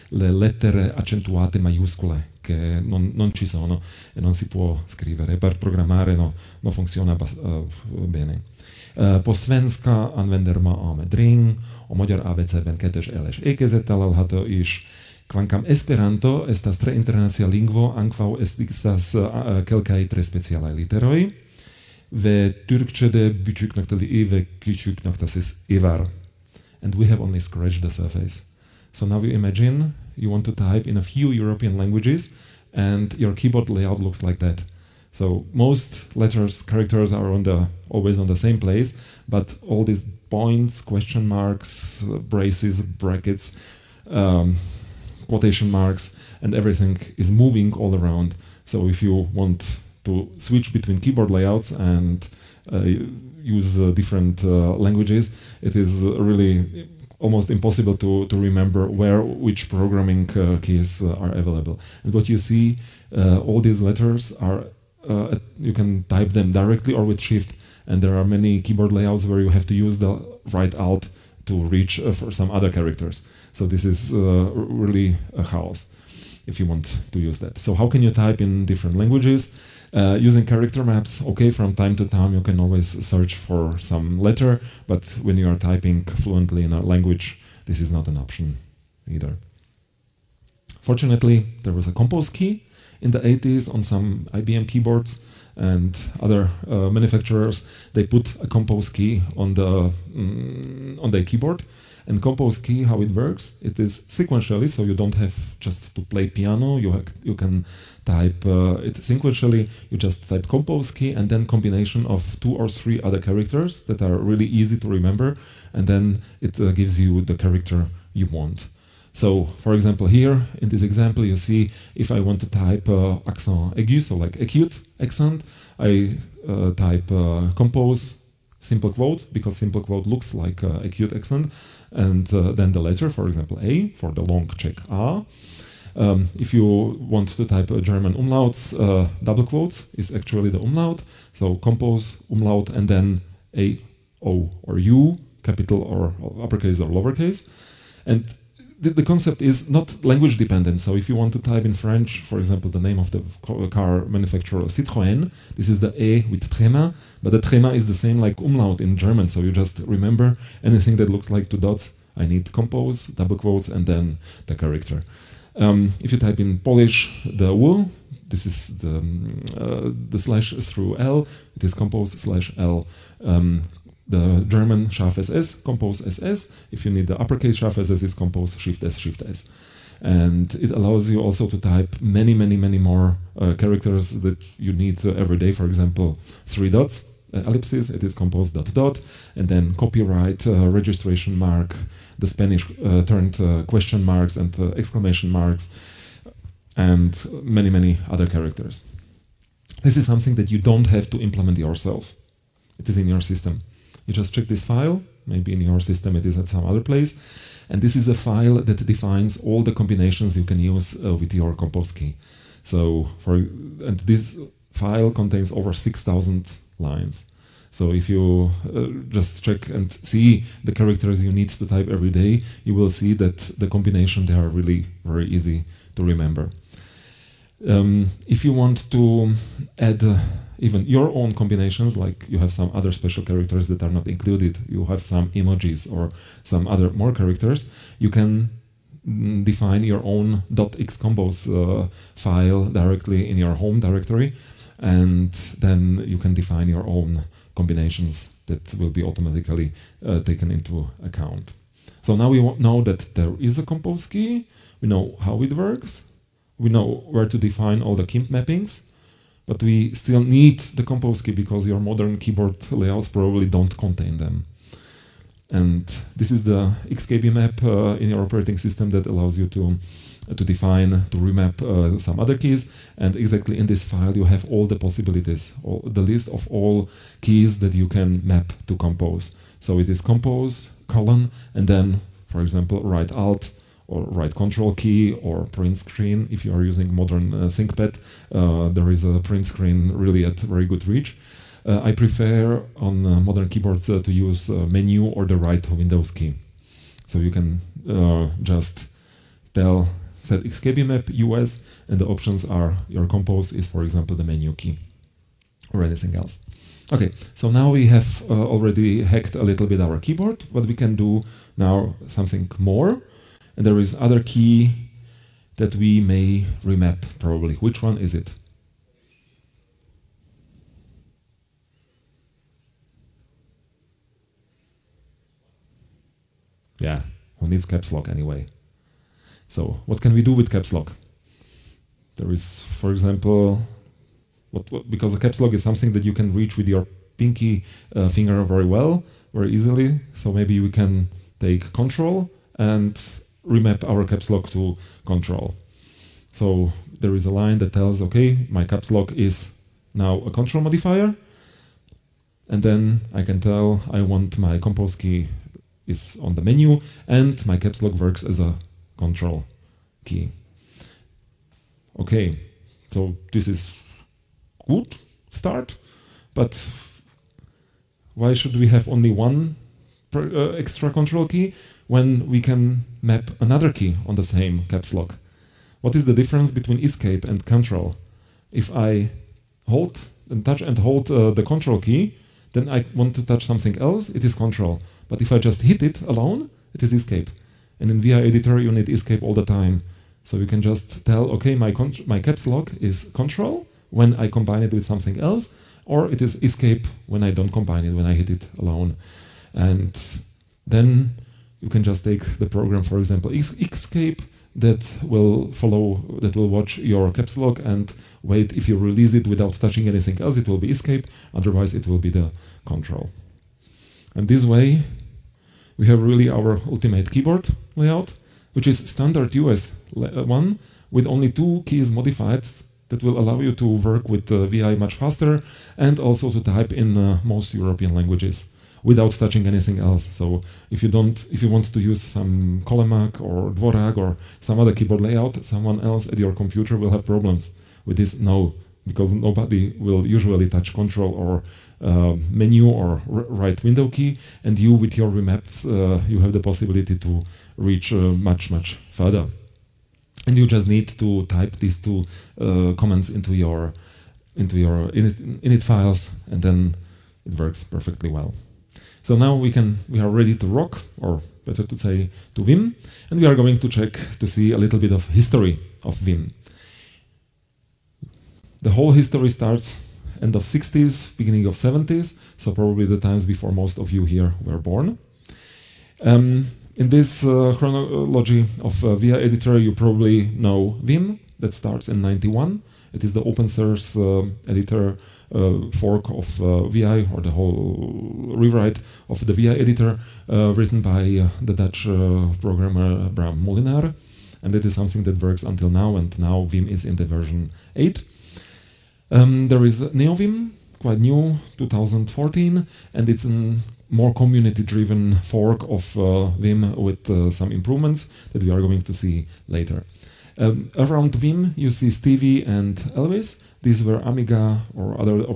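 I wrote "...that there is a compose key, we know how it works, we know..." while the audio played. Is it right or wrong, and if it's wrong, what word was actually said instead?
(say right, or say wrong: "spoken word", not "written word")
right.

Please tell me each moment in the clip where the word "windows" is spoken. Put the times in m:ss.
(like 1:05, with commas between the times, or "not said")
4:55, 7:23.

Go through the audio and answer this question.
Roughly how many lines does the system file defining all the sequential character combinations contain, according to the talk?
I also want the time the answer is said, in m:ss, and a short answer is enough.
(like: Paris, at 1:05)
over 6,000, at 3:35.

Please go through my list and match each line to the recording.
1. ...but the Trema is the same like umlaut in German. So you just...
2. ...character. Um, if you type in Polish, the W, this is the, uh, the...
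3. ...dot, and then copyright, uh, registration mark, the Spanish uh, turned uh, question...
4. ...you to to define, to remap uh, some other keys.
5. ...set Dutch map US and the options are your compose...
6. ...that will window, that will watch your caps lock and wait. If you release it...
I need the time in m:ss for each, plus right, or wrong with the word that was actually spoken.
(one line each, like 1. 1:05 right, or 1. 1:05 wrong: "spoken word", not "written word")
1. 2:37 right
2. 2:44 right
3. 3:08 right
4. 4:29 right
5. 5:00 wrong: "XKB", not "Dutch"
6. 6:44 wrong: "follow", not "window".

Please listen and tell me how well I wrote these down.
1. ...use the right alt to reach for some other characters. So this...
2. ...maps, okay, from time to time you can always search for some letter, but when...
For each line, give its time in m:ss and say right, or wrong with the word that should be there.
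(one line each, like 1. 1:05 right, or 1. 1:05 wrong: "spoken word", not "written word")
1. 1:09 right
2. 1:20 right.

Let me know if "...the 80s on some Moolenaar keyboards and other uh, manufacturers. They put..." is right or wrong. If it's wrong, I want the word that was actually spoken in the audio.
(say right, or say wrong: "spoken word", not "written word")
wrong: "IBM", not "Moolenaar".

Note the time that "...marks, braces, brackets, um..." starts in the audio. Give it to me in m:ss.
0:41.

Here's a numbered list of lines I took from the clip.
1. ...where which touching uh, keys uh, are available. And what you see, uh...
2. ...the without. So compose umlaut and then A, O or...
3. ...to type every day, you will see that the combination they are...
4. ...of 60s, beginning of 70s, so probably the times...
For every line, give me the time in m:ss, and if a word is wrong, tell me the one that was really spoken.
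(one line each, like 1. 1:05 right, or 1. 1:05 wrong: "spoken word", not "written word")
1. 0:58 wrong: "programming", not "touching"
2. 2:20 wrong: "umlaut", not "without"
3. 3:41 right
4. 7:50 right.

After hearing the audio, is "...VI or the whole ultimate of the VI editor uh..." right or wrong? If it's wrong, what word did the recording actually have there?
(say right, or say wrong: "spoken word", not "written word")
wrong: "rewrite", not "ultimate".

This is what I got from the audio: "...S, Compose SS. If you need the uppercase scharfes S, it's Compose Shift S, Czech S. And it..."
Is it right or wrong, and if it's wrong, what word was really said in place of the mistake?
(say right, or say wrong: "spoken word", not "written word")
wrong: "Shift", not "Czech".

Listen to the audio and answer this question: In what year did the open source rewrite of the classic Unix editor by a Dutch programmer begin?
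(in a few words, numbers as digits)
1991.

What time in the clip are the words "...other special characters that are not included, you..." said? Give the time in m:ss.
3:52.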